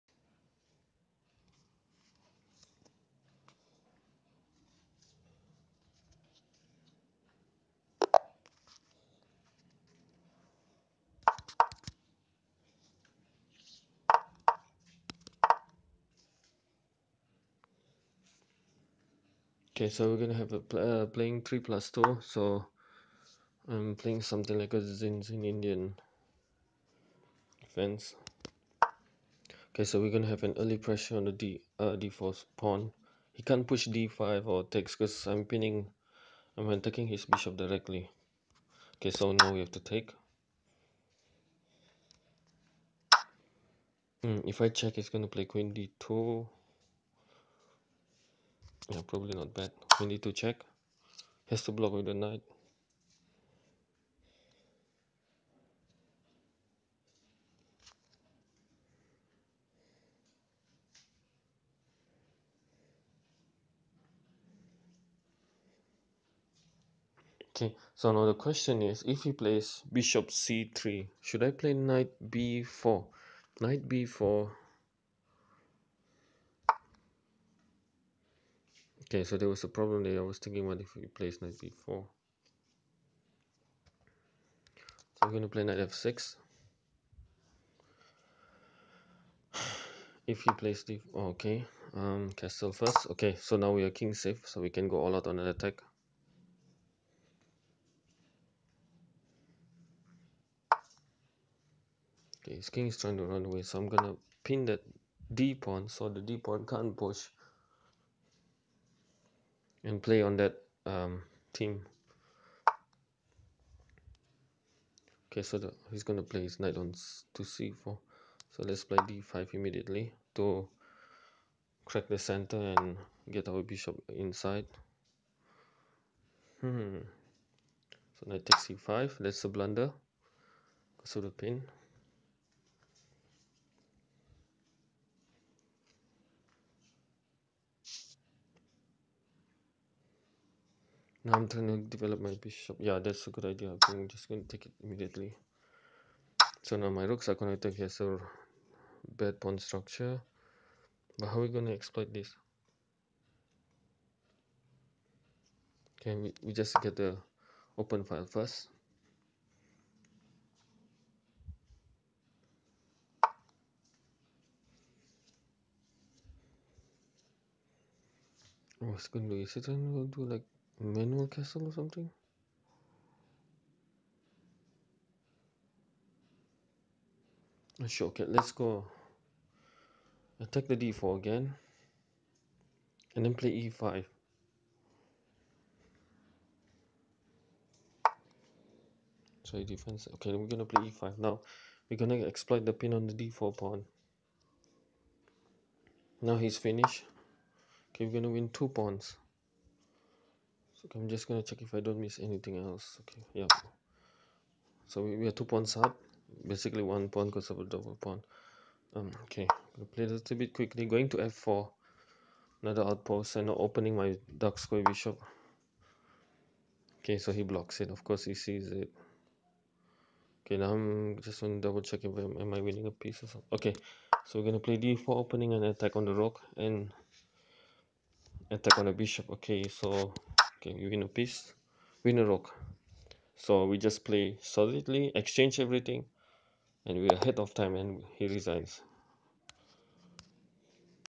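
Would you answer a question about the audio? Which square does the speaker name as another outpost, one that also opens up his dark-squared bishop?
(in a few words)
f4.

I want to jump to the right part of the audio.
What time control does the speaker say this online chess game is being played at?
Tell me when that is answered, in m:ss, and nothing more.
0:21.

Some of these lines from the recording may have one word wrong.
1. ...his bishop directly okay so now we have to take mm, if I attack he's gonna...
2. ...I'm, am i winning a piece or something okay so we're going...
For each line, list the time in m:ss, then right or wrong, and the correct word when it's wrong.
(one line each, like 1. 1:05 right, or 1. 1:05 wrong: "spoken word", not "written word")
1. 0:37 wrong: "check", not "attack"
2. 3:42 right.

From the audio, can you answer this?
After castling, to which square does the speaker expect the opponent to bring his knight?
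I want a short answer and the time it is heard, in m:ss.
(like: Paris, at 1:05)
c4, at 1:57.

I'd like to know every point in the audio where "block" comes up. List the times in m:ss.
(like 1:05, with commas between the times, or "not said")
0:51, 3:37.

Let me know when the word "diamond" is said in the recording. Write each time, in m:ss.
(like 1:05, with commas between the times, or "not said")
not said.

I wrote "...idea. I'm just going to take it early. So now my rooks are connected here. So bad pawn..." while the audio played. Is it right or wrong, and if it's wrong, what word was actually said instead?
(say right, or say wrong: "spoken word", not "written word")
wrong: "immediately", not "early".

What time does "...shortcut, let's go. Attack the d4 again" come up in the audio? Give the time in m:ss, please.
2:57.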